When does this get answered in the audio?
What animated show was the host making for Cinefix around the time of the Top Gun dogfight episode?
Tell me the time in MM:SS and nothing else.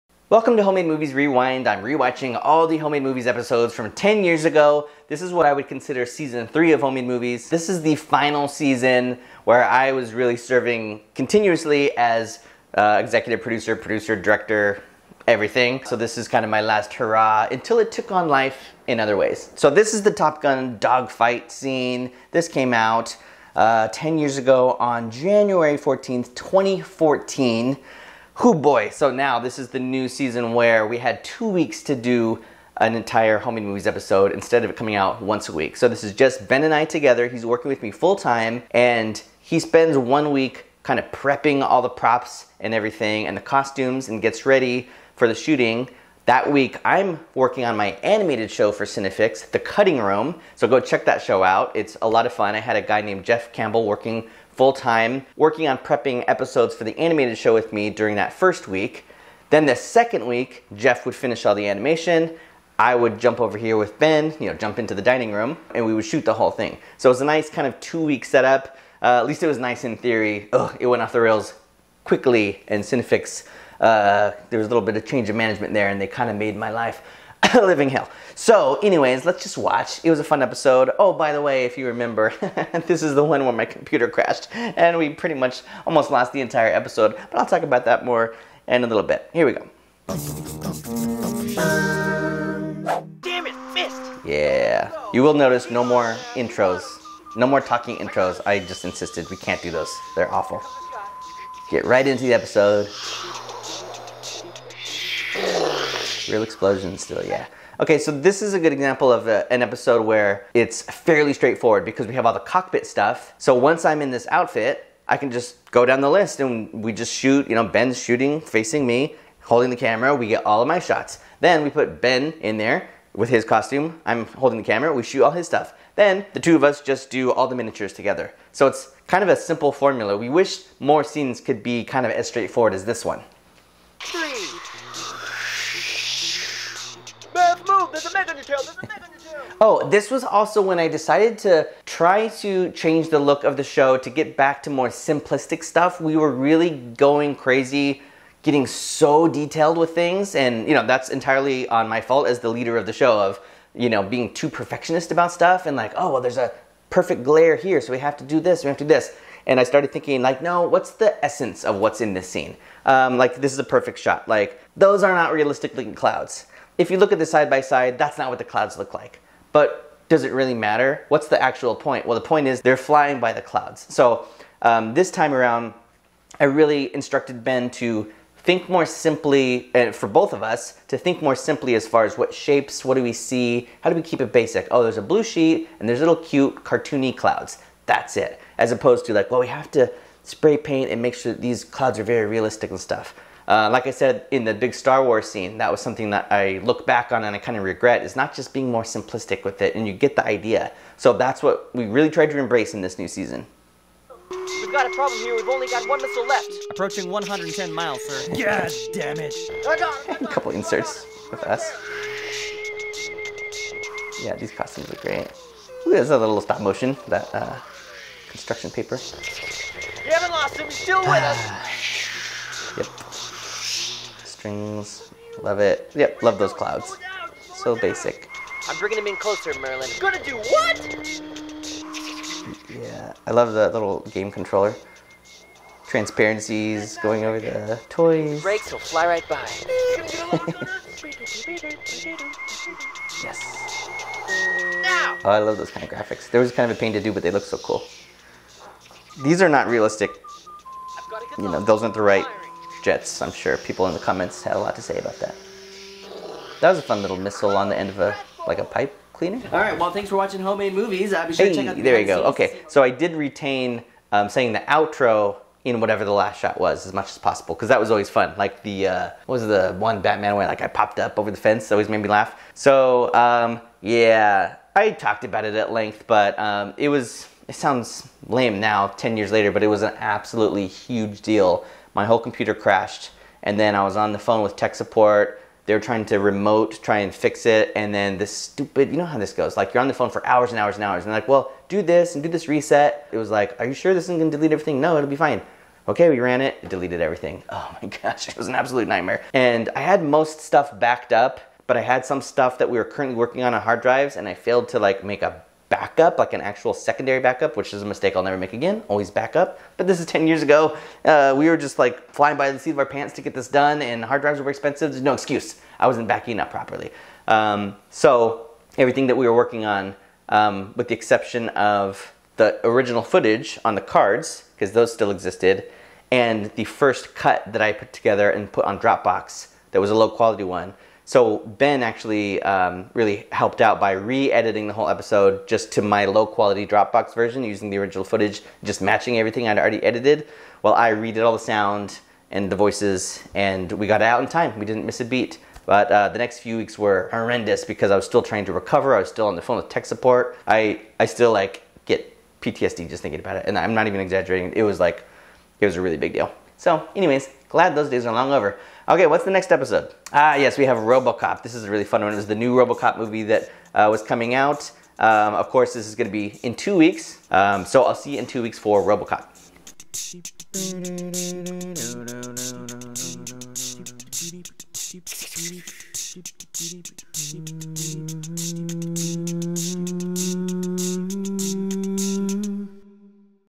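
00:49.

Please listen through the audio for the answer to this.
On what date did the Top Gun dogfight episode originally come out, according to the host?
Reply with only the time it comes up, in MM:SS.
00:25.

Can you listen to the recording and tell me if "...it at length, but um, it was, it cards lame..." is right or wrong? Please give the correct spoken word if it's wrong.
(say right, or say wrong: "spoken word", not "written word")
wrong: "sounds", not "cards".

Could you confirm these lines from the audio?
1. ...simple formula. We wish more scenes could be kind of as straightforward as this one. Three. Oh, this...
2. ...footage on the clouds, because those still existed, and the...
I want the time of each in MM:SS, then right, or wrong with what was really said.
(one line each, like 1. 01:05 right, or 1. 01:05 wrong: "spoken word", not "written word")
1. 02:09 right
2. 05:23 wrong: "cards", not "clouds".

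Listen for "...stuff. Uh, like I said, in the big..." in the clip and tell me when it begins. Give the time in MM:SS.
03:12.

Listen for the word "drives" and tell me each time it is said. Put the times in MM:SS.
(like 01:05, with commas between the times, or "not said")
05:03, 05:14.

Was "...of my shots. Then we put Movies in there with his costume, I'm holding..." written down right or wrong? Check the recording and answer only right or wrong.
wrong.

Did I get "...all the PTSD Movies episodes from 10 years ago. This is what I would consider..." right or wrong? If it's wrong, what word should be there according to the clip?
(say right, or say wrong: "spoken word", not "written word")
wrong: "Homemade", not "PTSD".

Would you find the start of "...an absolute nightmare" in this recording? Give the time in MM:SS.
04:58.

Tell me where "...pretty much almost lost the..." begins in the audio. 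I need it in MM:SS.
01:25.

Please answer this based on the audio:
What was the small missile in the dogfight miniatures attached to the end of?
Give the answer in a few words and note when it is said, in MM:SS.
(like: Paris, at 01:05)
a pipe cleaner, at 04:18.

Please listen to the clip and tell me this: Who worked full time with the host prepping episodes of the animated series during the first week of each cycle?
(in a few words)
Jeff Campbell.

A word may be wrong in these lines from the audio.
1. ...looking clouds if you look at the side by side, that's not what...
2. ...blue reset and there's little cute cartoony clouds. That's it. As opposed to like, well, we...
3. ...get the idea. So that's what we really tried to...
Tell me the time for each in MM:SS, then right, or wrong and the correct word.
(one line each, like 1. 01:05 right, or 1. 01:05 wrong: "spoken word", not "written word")
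1. 02:45 right
2. 03:05 wrong: "sheet", not "reset"
3. 03:19 right.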